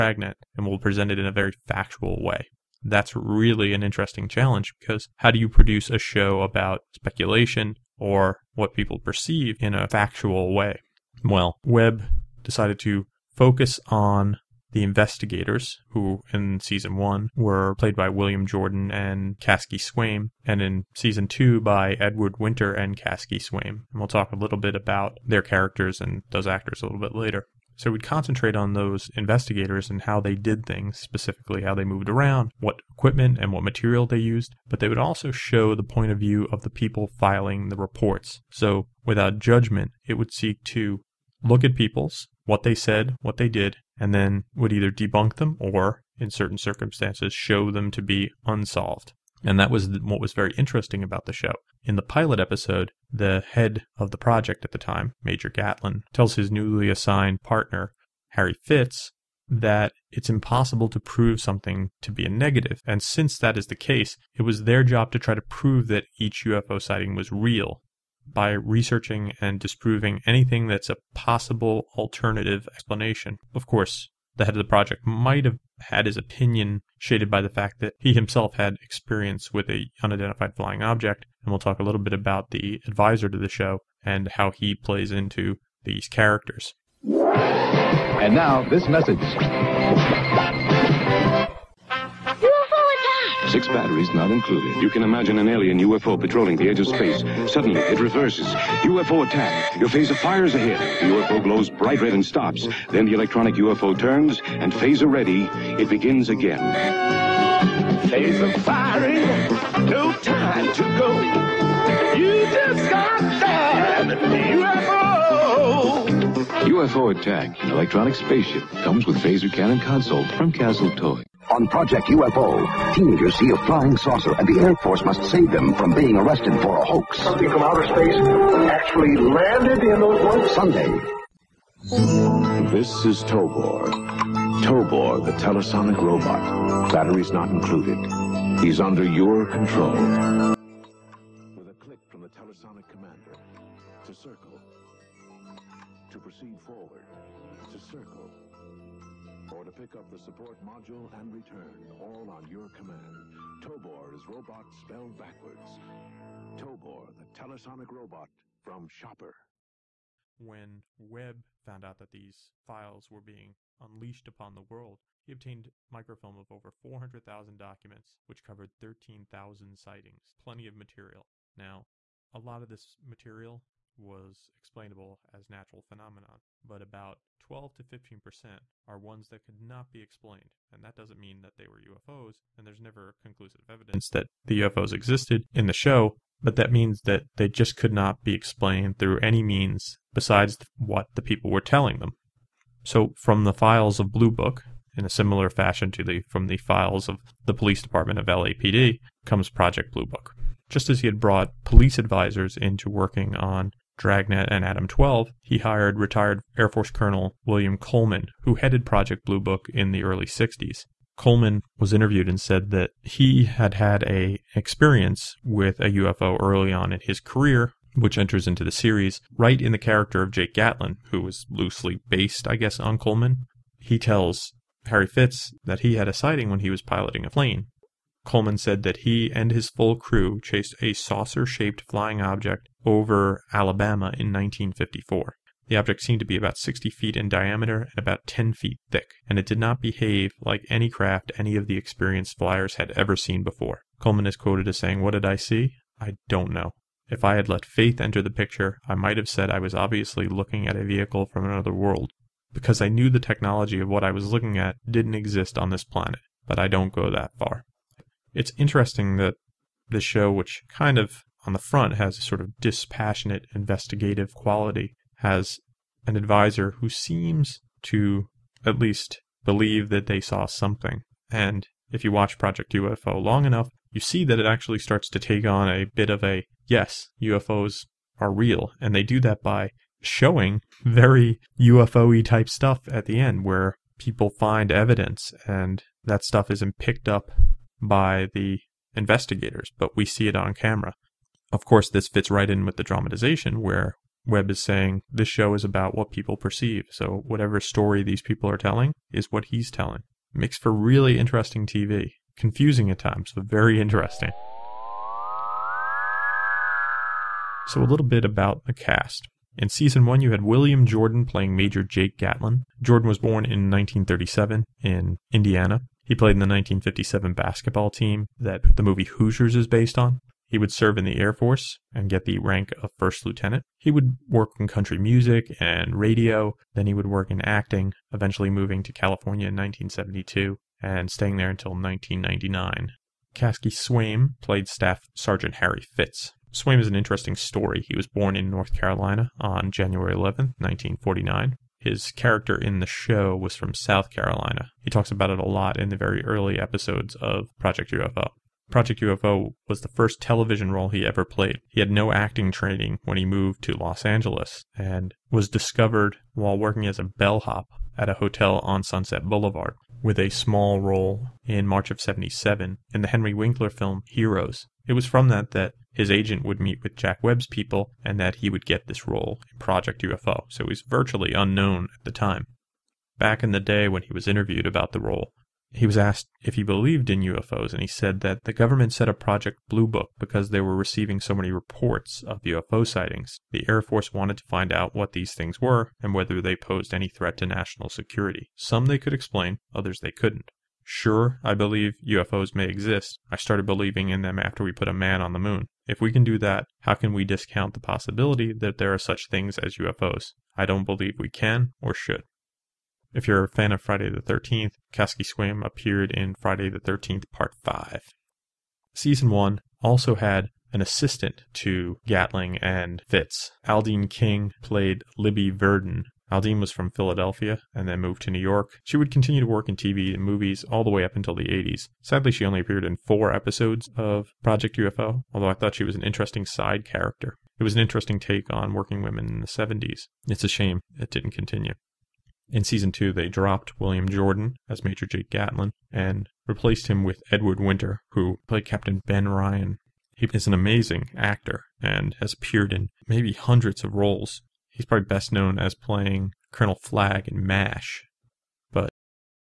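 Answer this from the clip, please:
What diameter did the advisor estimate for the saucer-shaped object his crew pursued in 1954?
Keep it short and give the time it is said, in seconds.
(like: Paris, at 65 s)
60 feet, at 236 s.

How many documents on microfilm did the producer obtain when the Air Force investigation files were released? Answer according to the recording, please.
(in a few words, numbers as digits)
400,000.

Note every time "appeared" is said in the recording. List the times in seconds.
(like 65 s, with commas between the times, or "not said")
405 s, 422 s, 442 s.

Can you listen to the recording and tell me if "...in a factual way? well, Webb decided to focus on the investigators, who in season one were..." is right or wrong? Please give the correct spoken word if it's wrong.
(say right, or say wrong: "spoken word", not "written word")
right.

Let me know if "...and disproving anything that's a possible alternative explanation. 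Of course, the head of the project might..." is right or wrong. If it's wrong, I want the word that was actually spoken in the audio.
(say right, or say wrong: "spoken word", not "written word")
right.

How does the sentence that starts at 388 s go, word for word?
Some they could explain, others they couldn't.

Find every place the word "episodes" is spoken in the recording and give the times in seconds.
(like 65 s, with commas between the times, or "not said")
52 s, 346 s, 423 s.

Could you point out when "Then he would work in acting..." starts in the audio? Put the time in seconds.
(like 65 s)
326 s.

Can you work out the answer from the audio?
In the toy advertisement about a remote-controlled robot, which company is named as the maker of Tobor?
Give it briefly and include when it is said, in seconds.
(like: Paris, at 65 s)
Schaper, at 158 s.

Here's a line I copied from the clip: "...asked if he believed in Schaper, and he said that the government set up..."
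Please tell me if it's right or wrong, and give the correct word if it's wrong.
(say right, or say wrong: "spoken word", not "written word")
wrong: "UFOs", not "Schaper".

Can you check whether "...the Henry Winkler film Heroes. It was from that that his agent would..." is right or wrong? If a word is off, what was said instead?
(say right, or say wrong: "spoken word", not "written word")
right.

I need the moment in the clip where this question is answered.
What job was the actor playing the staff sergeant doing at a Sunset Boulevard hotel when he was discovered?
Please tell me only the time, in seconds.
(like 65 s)
357 s.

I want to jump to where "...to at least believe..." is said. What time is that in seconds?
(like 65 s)
267 s.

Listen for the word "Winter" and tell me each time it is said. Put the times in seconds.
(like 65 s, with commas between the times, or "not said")
22 s, 437 s.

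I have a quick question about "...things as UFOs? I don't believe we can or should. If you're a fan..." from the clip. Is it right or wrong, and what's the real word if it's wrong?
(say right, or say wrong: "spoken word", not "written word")
right.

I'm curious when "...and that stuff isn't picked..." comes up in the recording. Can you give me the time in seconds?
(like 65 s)
285 s.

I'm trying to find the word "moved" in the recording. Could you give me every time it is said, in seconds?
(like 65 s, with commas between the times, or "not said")
31 s, 353 s, 418 s.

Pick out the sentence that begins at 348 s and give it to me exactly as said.
Project UFO was the first television role he ever played.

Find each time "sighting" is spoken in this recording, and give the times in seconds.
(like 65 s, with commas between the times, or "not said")
66 s, 169 s, 226 s, 382 s.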